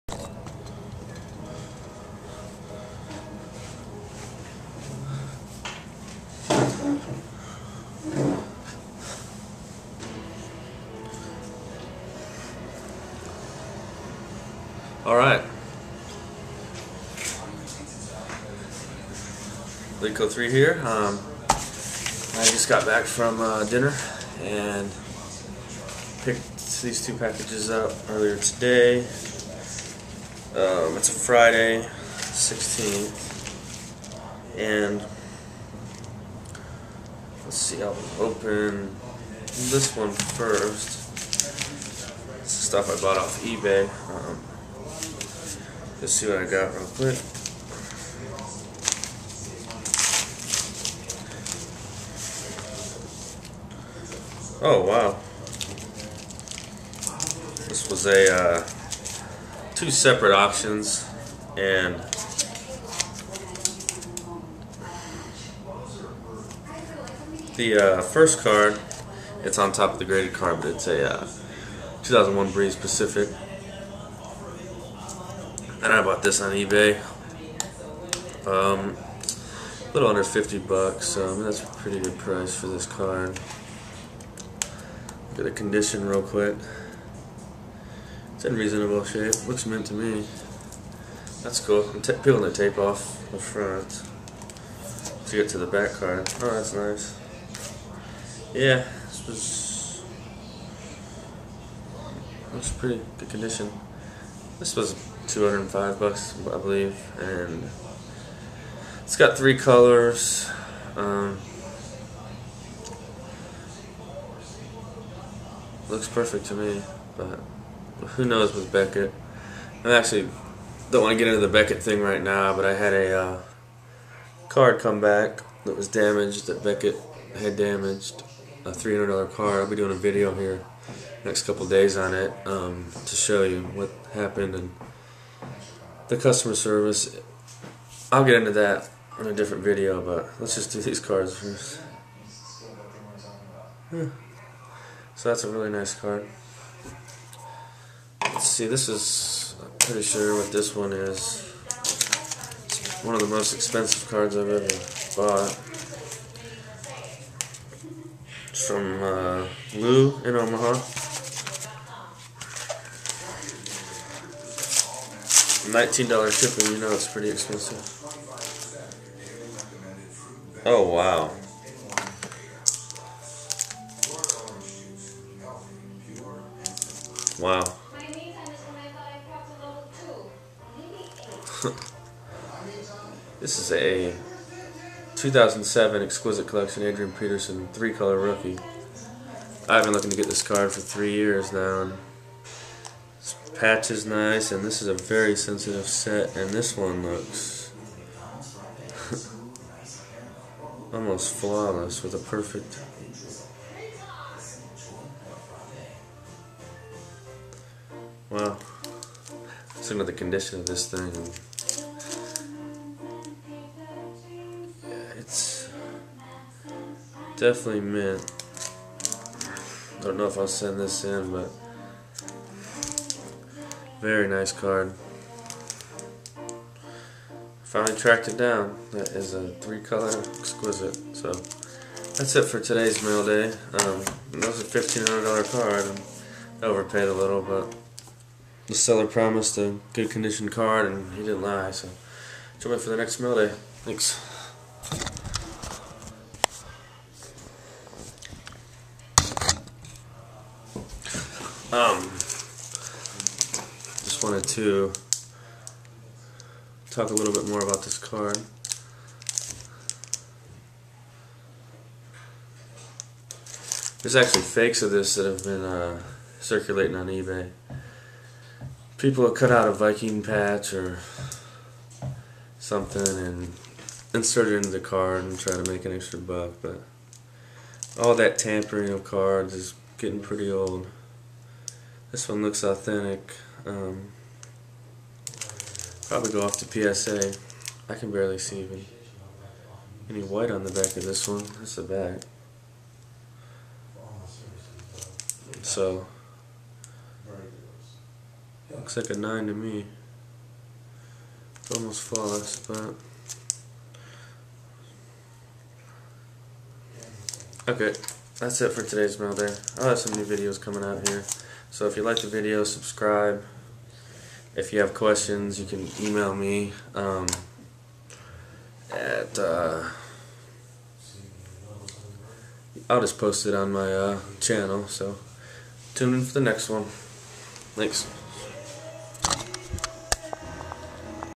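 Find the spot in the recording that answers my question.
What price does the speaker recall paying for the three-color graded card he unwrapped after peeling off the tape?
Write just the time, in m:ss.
1:45.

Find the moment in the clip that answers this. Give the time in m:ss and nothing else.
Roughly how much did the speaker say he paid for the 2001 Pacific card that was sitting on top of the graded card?
1:19.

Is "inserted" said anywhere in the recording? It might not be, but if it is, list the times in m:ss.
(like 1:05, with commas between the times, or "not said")
4:34.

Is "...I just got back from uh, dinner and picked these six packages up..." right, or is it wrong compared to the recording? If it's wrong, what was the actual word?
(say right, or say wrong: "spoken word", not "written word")
wrong: "two", not "six".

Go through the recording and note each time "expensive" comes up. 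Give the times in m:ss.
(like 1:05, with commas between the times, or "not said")
2:33, 2:47.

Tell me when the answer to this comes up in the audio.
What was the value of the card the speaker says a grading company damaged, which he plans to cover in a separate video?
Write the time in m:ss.
2:08.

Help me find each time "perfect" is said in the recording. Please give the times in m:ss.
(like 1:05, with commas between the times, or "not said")
1:56, 3:22.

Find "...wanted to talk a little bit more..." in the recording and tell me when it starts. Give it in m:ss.
4:14.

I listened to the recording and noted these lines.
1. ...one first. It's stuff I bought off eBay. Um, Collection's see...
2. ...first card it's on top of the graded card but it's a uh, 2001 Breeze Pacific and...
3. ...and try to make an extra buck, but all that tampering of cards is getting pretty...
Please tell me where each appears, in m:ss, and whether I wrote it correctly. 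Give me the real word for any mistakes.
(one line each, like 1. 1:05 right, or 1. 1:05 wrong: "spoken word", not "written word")
1. 0:39 wrong: "Let", not "Collection"
2. 1:08 right
3. 4:35 right.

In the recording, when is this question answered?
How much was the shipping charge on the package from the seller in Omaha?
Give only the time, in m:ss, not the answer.
2:40.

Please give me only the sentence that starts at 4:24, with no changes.
There's actually fakes of this that have been uh, circulating on eBay.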